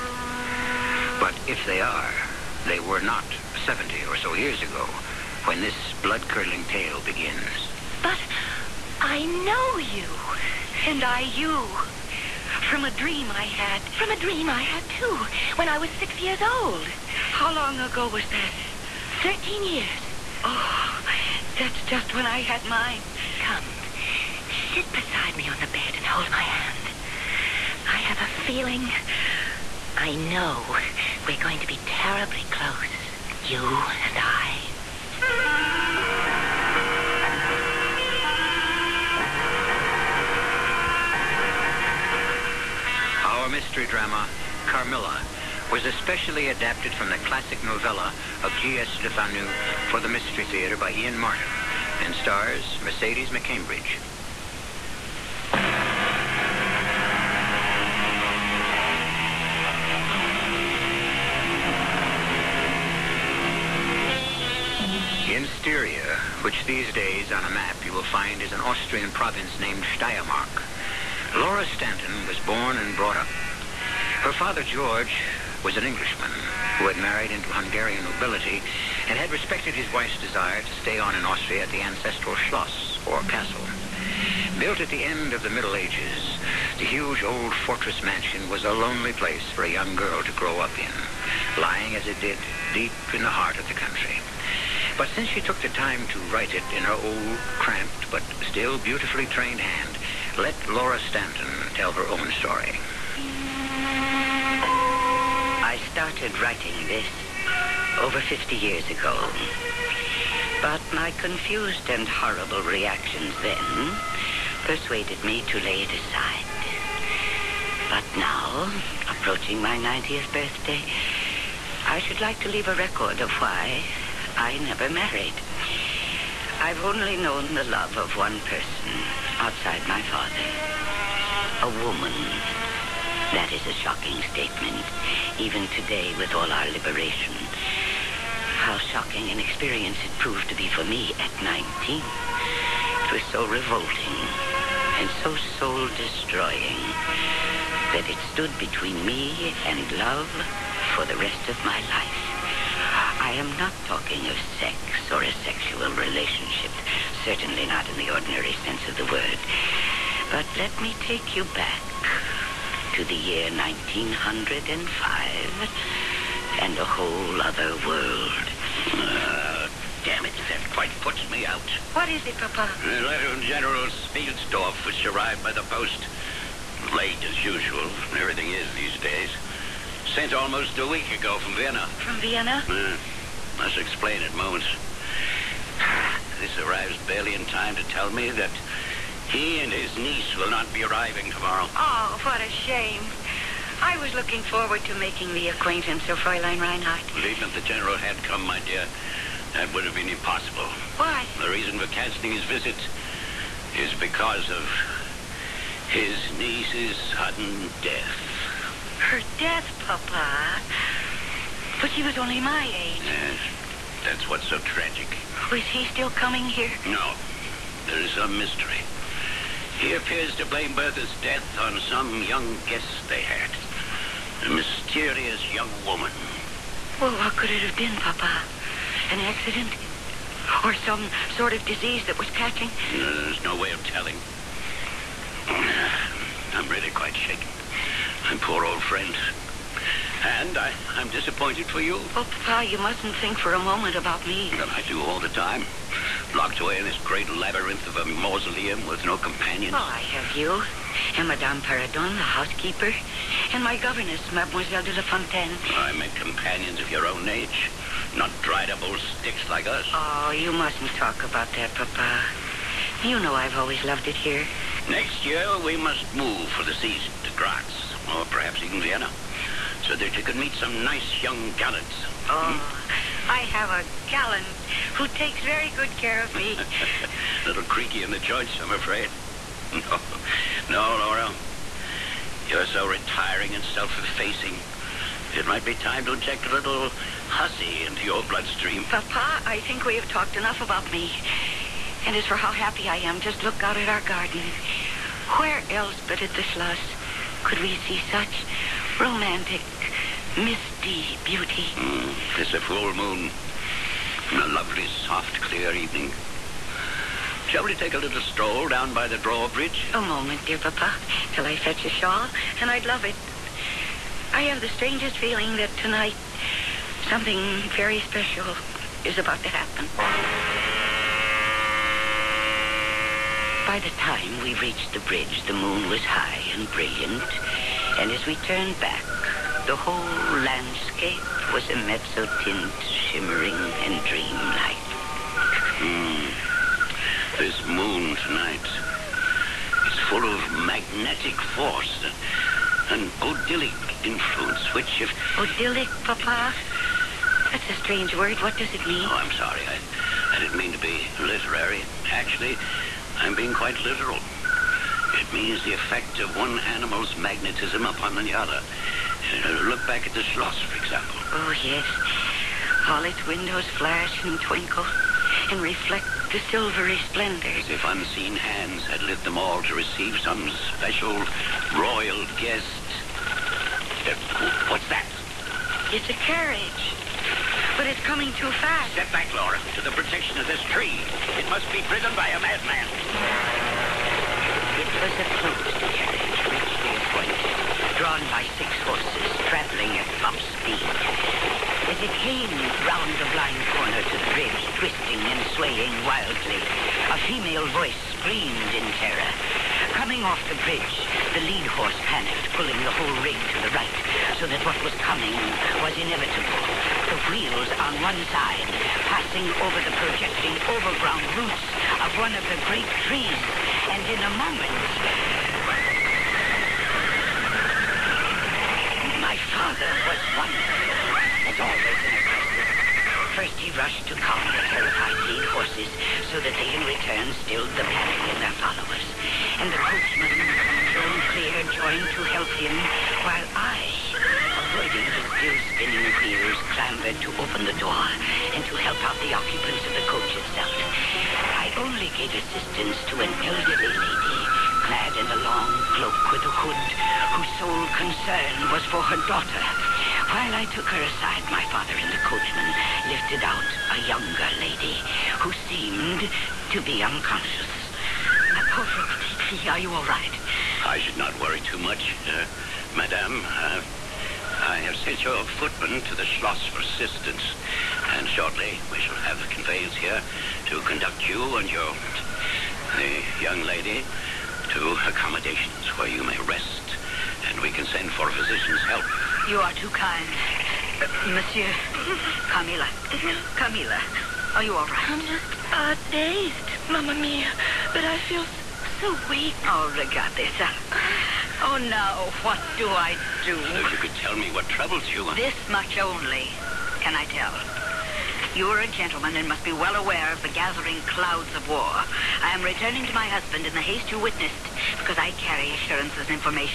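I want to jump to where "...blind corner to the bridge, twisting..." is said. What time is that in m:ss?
6:33.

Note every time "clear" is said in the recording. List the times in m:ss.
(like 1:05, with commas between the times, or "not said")
5:05, 7:11.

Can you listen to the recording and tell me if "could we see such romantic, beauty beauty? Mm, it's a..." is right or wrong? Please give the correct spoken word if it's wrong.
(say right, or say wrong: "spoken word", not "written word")
wrong: "misty", not "beauty".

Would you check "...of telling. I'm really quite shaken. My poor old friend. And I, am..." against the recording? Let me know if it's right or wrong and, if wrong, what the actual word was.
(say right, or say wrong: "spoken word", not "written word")
right.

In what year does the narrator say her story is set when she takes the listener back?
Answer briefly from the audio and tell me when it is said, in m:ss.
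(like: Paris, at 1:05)
1905, at 2:43.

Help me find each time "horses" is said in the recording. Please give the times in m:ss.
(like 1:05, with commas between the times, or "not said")
6:28, 6:41, 7:05.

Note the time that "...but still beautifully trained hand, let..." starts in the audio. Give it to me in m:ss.
1:38.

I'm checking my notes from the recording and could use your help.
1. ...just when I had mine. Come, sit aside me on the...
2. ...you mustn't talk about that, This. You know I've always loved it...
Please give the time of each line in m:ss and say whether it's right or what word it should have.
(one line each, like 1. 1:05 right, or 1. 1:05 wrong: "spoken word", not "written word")
1. 0:21 wrong: "beside", not "aside"
2. 4:20 wrong: "Papa", not "This".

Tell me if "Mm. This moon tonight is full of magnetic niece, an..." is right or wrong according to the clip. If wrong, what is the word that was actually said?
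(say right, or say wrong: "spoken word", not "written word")
wrong: "force", not "niece".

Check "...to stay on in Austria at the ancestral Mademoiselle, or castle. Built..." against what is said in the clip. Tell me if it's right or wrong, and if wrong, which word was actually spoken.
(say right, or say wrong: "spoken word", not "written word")
wrong: "Schloss", not "Mademoiselle".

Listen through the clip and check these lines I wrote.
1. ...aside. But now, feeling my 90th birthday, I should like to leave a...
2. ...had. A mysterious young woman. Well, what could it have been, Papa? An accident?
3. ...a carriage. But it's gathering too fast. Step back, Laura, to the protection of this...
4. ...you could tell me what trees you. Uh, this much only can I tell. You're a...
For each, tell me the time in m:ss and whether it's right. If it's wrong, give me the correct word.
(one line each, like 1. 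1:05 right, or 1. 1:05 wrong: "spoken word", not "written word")
1. 1:55 wrong: "approaching", not "feeling"
2. 3:43 right
3. 6:16 wrong: "coming", not "gathering"
4. 8:13 wrong: "troubles", not "trees".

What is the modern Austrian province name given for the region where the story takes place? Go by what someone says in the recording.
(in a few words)
Steiermark.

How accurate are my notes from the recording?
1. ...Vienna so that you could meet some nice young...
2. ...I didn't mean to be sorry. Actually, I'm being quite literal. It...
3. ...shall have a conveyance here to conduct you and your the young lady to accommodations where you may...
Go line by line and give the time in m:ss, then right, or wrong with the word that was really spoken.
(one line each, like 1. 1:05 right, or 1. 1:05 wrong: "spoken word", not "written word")
1. 4:28 right
2. 5:50 wrong: "literary", not "sorry"
3. 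7:48 right.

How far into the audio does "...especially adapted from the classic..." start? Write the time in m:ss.
0:45.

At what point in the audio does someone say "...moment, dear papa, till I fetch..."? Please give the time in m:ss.
5:10.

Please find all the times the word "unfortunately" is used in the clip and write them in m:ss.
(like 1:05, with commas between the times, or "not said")
not said.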